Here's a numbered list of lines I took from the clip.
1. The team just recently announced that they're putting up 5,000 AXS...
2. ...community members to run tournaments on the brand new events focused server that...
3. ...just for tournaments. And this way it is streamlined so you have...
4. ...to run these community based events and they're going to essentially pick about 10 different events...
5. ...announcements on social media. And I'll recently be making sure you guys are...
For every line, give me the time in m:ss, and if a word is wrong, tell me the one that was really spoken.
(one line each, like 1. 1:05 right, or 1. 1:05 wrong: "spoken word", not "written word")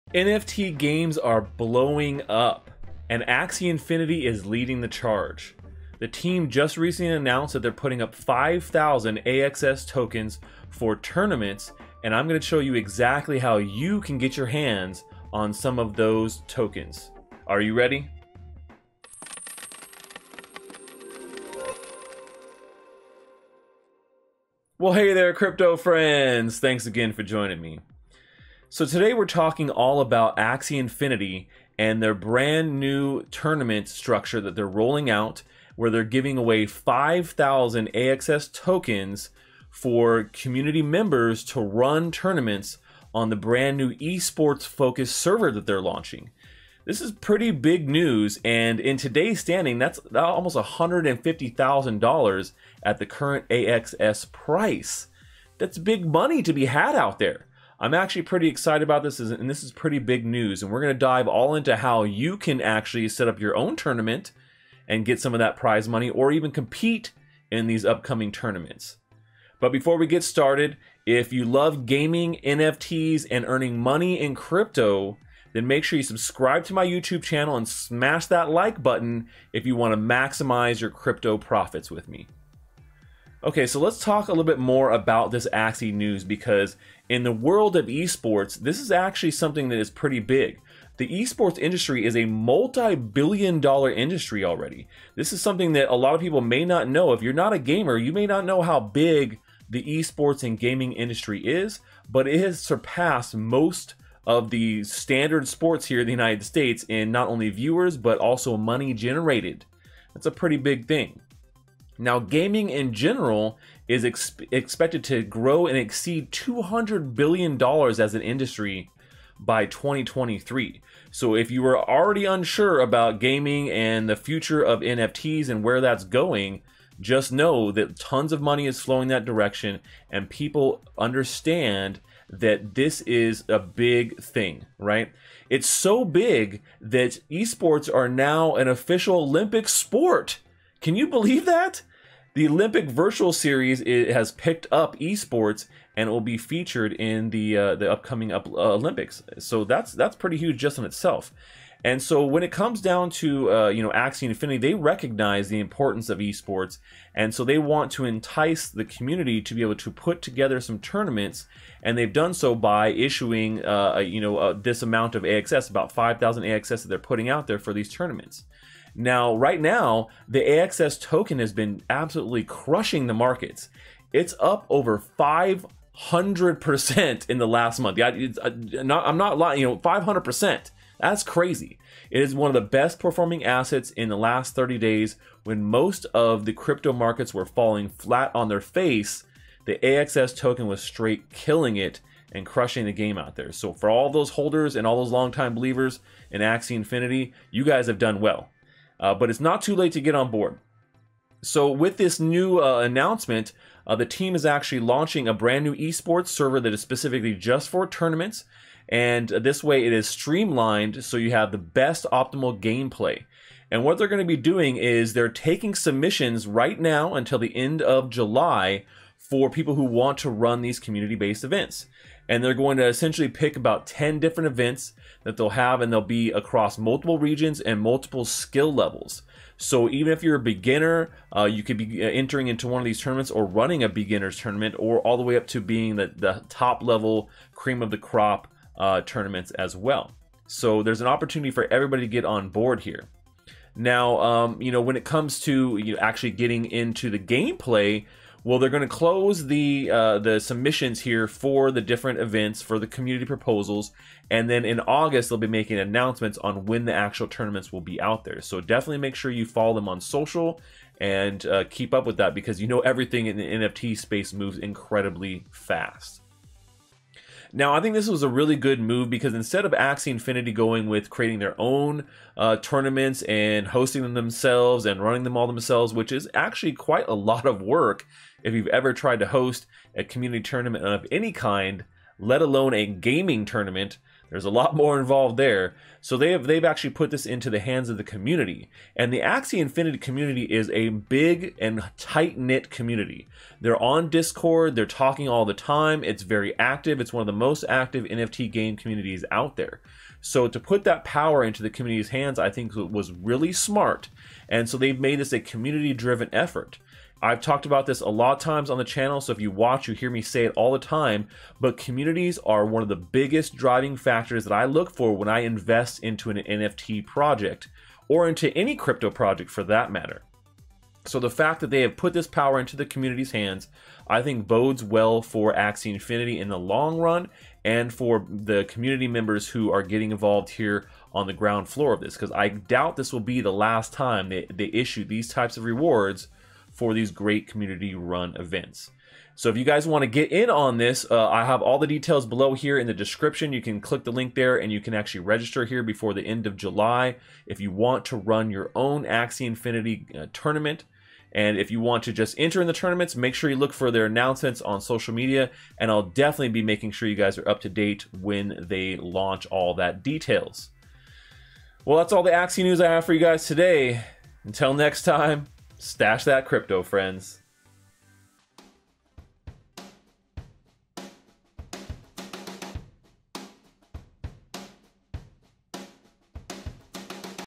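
1. 0:05 right
2. 0:40 wrong: "esports", not "events"
3. 3:27 right
4. 3:40 right
5. 5:54 wrong: "definitely", not "recently".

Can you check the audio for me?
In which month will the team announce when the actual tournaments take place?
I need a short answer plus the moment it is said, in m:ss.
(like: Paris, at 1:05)
August, at 4:14.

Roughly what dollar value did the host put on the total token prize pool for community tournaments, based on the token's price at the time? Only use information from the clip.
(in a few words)
$150,000.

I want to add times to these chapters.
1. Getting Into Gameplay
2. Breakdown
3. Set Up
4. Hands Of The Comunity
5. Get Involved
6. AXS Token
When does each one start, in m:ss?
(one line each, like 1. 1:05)
1. 4:03
2. 1:22
3. 0:24
4. 4:26
5. 5:38
6. 2:48.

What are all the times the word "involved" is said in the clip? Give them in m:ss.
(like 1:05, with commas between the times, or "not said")
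4:44, 5:30.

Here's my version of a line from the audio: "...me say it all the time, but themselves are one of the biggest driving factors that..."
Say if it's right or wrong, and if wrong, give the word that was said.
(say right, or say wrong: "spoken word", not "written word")
wrong: "communities", not "themselves".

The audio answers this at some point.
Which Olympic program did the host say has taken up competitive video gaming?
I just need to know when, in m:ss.
2:22.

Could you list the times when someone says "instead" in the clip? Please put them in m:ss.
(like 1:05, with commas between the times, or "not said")
4:29.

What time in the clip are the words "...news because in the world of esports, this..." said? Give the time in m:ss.
1:25.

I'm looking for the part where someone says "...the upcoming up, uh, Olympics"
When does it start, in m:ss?
2:27.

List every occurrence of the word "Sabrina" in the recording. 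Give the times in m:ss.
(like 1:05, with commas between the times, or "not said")
not said.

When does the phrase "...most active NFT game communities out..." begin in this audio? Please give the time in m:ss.
4:57.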